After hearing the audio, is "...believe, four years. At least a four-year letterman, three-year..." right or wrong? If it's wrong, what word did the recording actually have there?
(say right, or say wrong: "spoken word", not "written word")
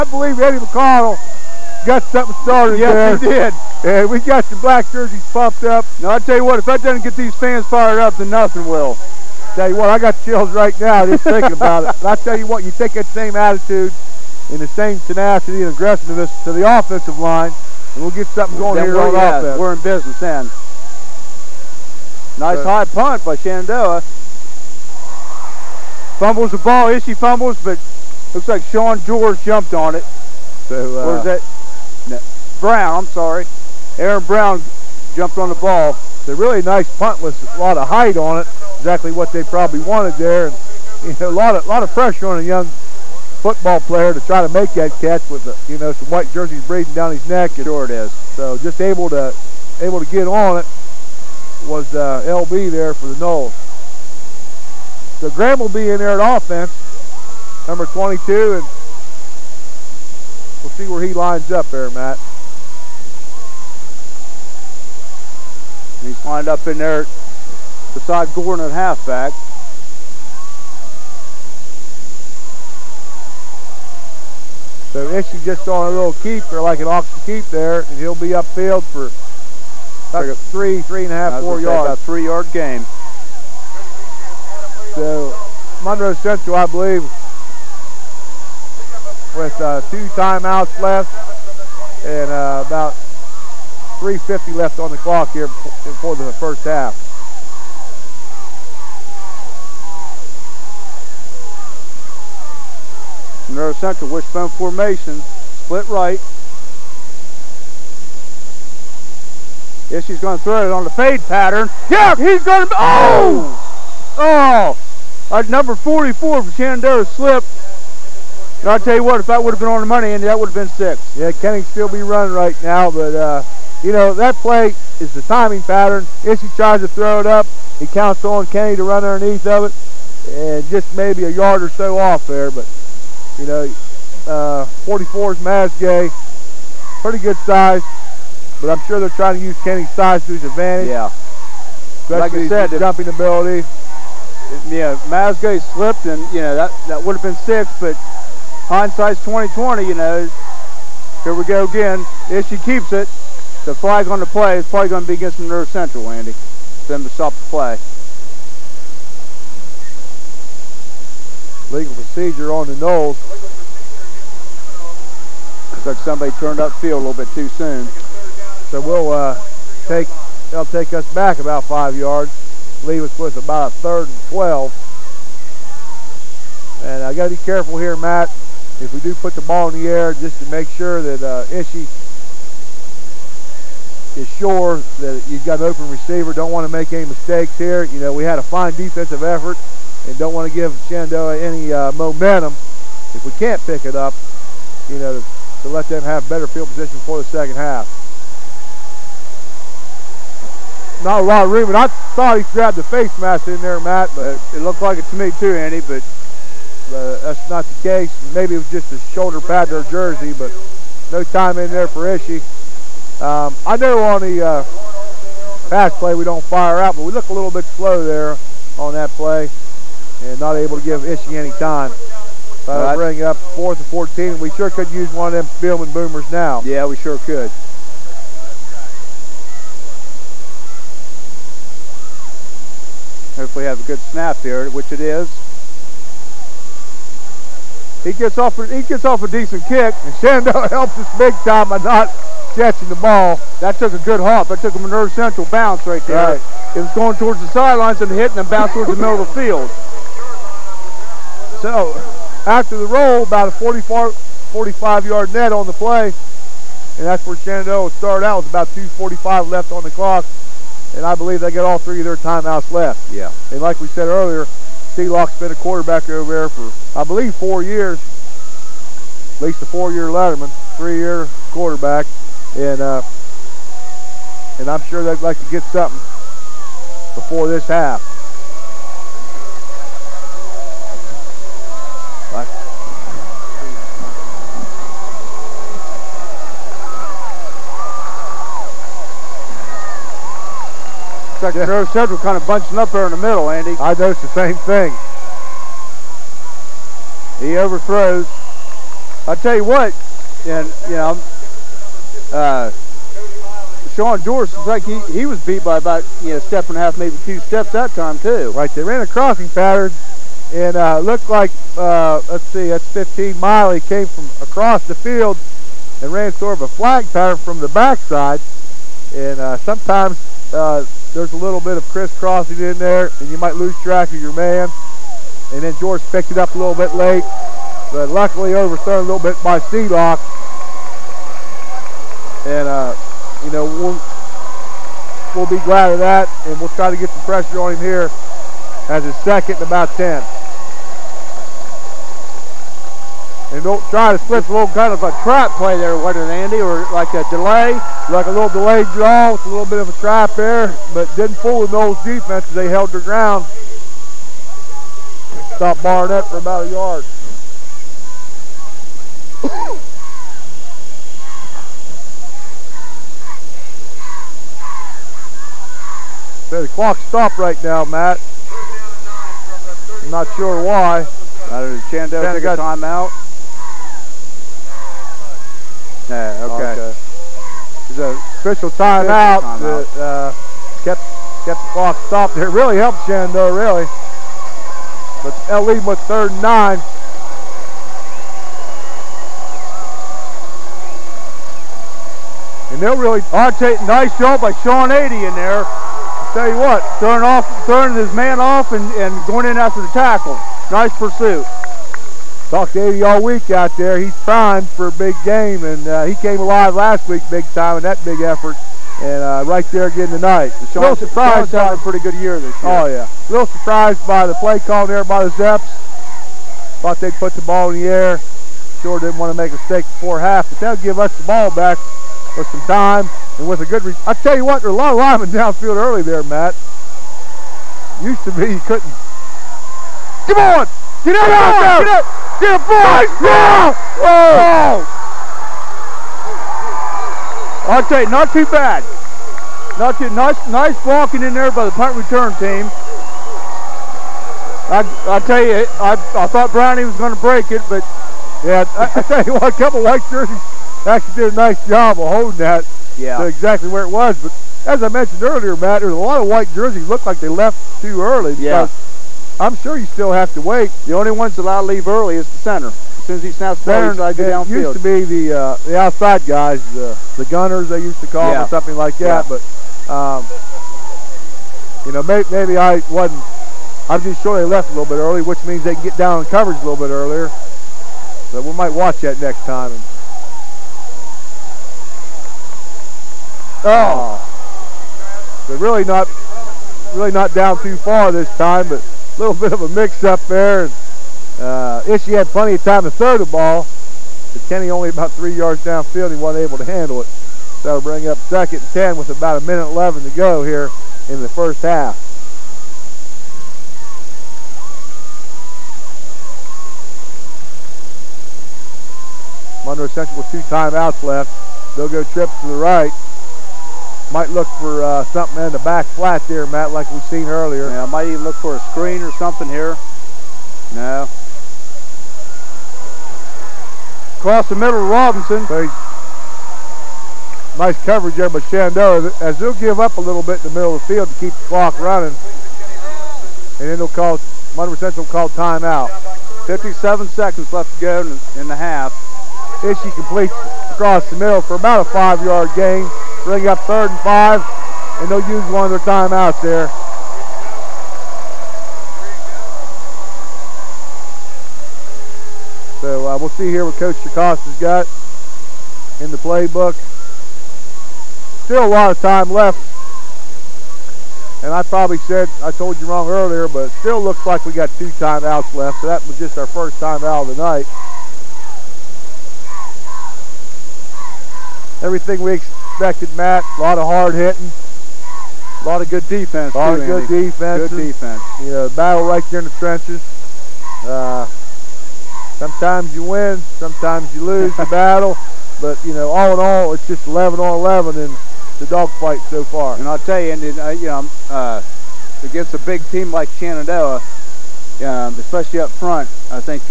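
right.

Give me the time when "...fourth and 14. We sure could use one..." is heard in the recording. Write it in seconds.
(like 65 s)
223 s.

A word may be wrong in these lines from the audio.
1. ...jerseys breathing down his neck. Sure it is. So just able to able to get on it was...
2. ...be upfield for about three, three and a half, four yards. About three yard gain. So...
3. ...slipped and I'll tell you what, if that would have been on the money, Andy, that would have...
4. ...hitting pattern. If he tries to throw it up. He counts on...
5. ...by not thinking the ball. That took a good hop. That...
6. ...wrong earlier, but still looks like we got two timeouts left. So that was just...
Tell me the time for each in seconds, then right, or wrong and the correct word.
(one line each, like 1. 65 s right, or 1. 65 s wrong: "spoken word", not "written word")
1. 46 s right
2. 78 s right
3. 117 s right
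4. 125 s wrong: "timing", not "hitting"
5. 241 s wrong: "catching", not "thinking"
6. 562 s right.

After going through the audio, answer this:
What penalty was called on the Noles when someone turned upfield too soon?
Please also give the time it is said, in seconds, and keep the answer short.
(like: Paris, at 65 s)
Legal procedure, at 161 s.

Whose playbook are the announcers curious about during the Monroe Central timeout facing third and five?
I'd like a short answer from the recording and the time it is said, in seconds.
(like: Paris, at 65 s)
Coach Jacosta, at 553 s.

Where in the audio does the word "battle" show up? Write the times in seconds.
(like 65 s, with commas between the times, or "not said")
578 s, 584 s.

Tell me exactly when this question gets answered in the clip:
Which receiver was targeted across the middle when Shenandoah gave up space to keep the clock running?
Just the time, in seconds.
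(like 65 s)
524 s.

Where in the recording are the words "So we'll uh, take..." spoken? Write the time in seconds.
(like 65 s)
168 s.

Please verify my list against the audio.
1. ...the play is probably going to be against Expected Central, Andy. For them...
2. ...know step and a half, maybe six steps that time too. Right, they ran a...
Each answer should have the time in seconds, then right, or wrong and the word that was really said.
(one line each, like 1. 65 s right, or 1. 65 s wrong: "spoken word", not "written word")
1. 154 s wrong: "Monroe", not "Expected"
2. 306 s wrong: "two", not "six".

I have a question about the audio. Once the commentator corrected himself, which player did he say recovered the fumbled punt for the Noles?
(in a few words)
Aaron Brown.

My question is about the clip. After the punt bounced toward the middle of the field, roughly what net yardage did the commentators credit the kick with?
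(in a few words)
45 yards.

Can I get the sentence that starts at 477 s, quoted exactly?
So we might watch that next time.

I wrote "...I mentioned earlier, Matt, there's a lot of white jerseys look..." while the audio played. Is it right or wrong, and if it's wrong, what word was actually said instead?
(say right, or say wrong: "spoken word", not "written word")
right.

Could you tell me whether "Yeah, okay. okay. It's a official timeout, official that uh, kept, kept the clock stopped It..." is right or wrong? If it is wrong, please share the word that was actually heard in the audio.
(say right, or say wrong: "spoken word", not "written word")
right.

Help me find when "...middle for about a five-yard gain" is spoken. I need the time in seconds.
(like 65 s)
541 s.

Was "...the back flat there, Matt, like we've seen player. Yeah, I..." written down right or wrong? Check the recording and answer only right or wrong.
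wrong.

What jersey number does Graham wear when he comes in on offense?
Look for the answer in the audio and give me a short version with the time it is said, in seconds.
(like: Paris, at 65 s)
22, at 57 s.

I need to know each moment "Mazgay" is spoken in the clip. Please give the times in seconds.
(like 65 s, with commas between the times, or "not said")
135 s, 145 s.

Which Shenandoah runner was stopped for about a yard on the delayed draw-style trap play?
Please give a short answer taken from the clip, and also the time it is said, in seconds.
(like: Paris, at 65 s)
Barnett, at 355 s.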